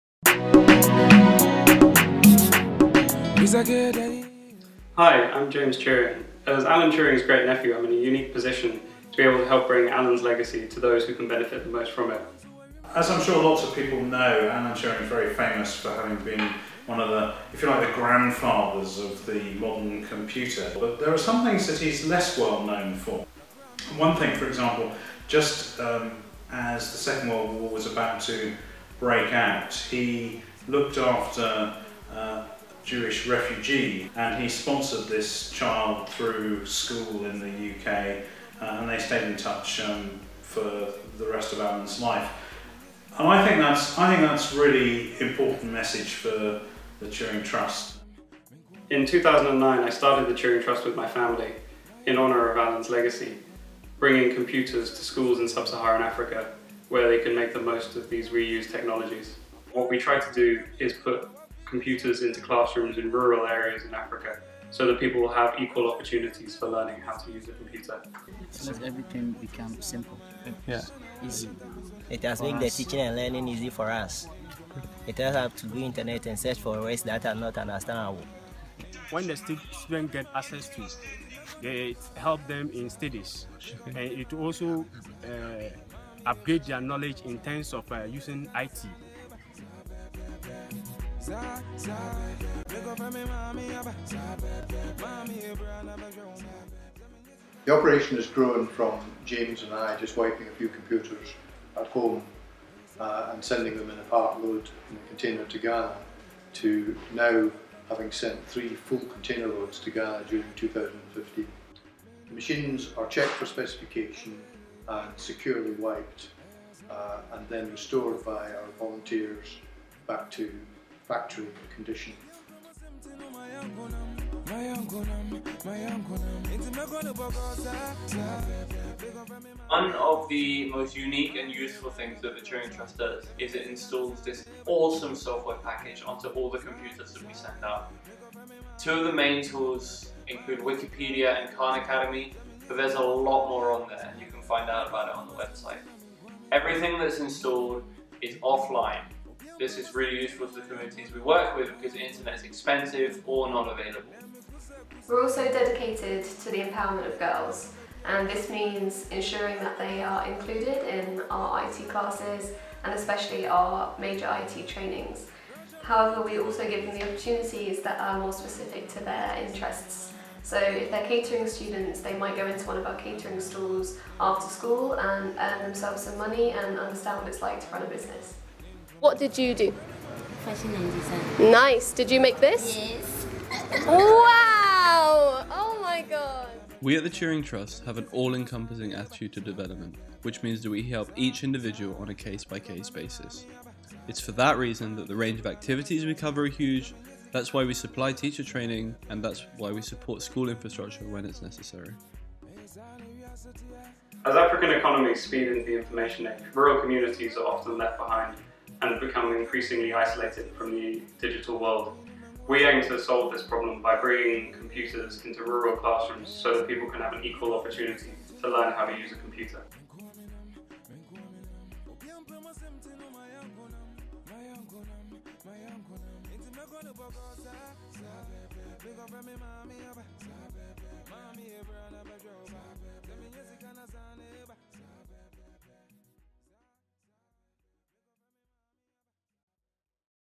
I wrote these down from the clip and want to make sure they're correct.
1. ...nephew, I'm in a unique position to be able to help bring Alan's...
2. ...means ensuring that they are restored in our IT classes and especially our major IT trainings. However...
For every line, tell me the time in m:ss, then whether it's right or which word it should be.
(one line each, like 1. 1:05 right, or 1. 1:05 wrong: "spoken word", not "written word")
1. 0:07 right
2. 2:38 wrong: "included", not "restored".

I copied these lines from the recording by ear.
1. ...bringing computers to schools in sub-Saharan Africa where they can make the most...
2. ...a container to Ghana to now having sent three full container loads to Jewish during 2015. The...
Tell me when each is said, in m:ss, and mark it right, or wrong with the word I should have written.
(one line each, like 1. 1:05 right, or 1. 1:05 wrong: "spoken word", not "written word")
1. 0:53 right
2. 1:44 wrong: "Ghana", not "Jewish".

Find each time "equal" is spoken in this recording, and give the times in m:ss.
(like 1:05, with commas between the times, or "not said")
1:05, 3:37.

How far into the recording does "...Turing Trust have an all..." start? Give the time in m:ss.
3:07.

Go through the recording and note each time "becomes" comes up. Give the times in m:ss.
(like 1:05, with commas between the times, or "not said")
1:09, 3:28.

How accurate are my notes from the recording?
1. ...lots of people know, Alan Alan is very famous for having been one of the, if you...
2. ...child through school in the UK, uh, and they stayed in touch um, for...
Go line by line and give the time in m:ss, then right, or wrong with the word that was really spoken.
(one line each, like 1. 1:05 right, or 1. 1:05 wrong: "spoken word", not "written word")
1. 0:13 wrong: "Turing", not "Alan"
2. 0:35 right.